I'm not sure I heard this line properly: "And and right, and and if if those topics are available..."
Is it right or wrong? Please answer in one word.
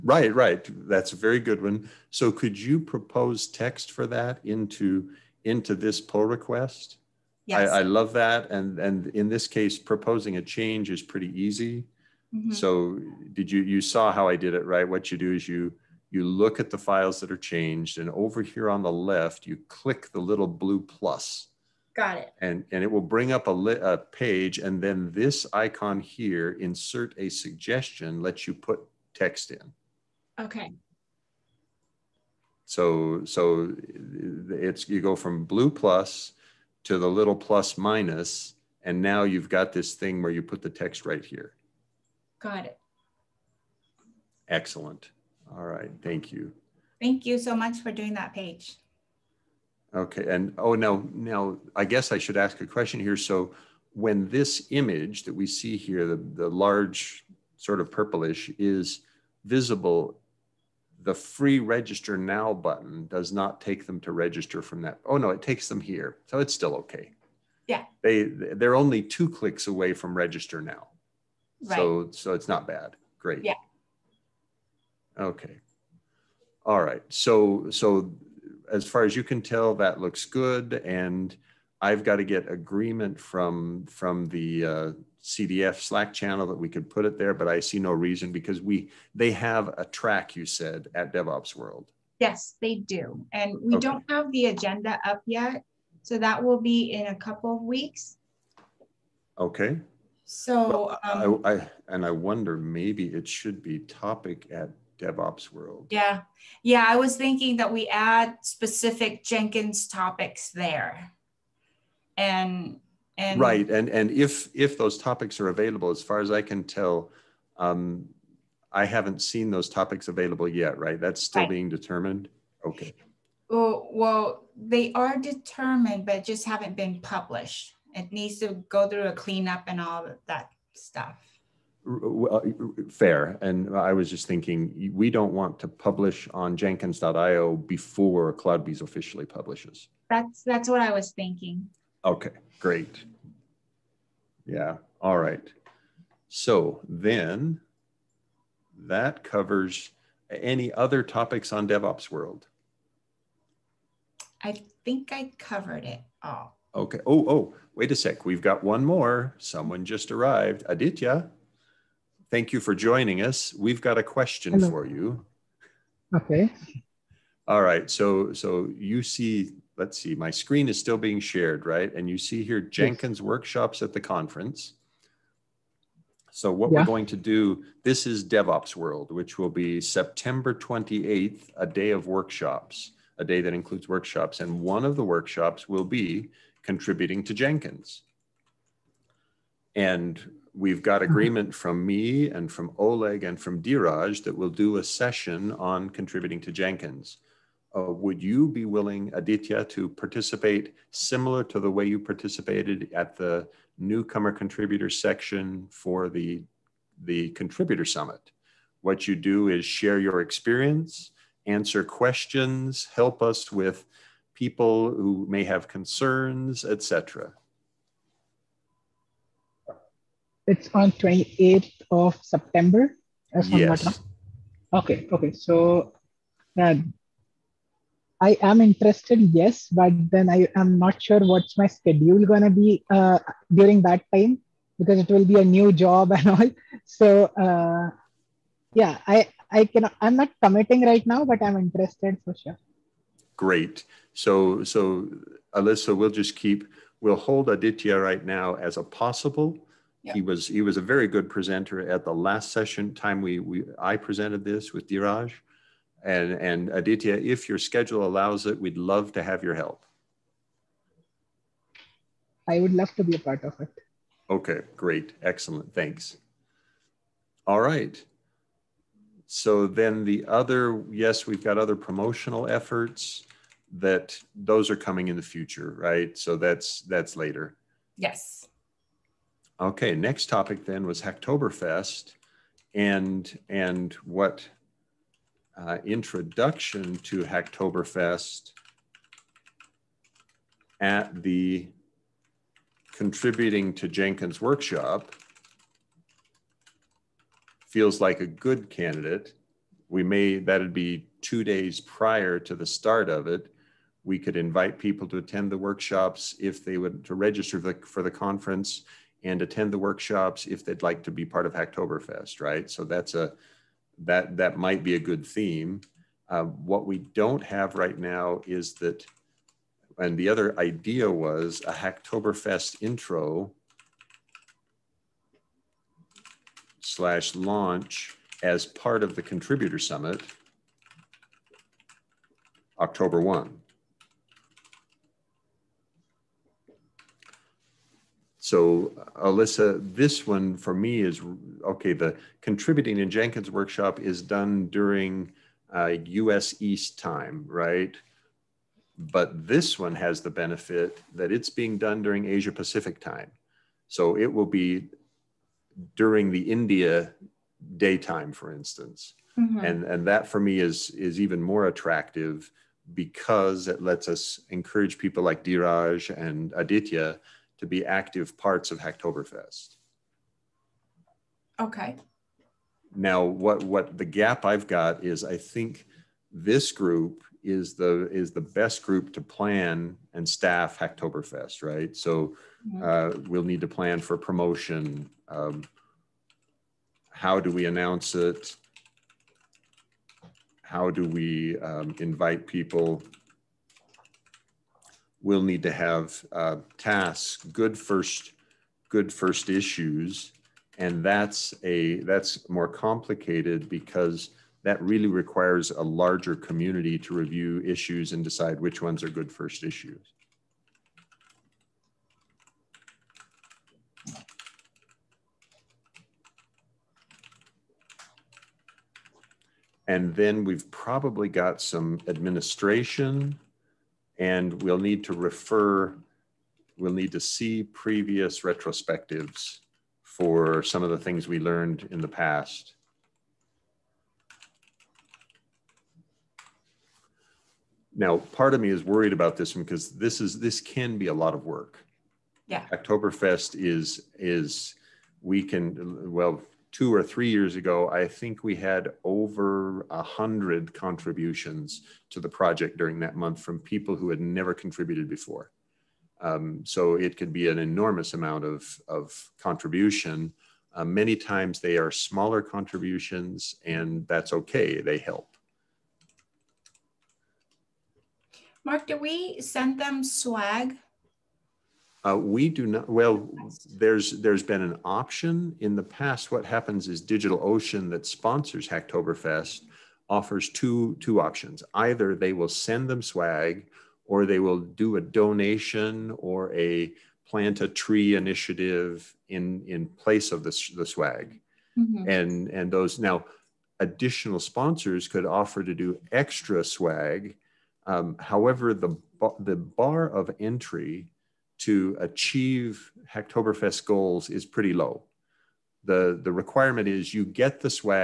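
right.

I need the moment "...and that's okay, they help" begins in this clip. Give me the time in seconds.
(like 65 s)
463 s.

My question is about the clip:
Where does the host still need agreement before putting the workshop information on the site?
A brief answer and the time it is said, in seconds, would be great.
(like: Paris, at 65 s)
CDF Slack channel, at 85 s.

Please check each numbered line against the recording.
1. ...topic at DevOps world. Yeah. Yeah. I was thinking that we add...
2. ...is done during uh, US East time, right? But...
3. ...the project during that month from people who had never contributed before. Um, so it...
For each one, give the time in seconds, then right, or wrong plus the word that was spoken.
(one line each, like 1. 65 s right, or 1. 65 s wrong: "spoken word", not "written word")
1. 103 s right
2. 343 s right
3. 452 s right.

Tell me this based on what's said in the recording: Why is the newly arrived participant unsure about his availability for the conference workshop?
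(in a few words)
a new job.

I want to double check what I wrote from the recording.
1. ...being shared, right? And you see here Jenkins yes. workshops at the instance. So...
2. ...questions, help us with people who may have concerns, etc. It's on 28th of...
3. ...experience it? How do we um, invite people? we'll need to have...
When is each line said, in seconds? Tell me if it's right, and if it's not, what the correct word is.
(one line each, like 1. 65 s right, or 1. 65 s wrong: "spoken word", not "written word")
1. 170 s wrong: "conference", not "instance"
2. 211 s right
3. 387 s wrong: "announce", not "experience".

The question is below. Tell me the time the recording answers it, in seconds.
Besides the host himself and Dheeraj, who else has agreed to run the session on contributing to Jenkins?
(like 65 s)
192 s.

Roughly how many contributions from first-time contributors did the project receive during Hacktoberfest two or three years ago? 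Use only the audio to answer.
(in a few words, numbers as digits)
over 100.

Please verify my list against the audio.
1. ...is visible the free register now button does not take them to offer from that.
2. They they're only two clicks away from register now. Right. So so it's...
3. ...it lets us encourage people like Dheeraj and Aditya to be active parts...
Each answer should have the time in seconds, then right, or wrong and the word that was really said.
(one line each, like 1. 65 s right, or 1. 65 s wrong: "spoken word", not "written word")
1. 58 s wrong: "register", not "offer"
2. 68 s right
3. 363 s right.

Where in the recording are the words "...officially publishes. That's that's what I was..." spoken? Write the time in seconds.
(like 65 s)
138 s.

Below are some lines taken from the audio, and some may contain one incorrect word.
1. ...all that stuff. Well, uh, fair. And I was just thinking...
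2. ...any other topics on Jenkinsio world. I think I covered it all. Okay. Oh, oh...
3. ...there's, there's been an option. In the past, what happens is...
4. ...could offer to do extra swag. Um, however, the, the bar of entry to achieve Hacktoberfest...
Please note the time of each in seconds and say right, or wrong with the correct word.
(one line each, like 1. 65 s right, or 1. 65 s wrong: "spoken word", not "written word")
1. 129 s right
2. 150 s wrong: "DevOps", not "Jenkinsio"
3. 473 s right
4. 495 s right.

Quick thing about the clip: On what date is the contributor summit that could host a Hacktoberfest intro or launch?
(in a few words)
October 1.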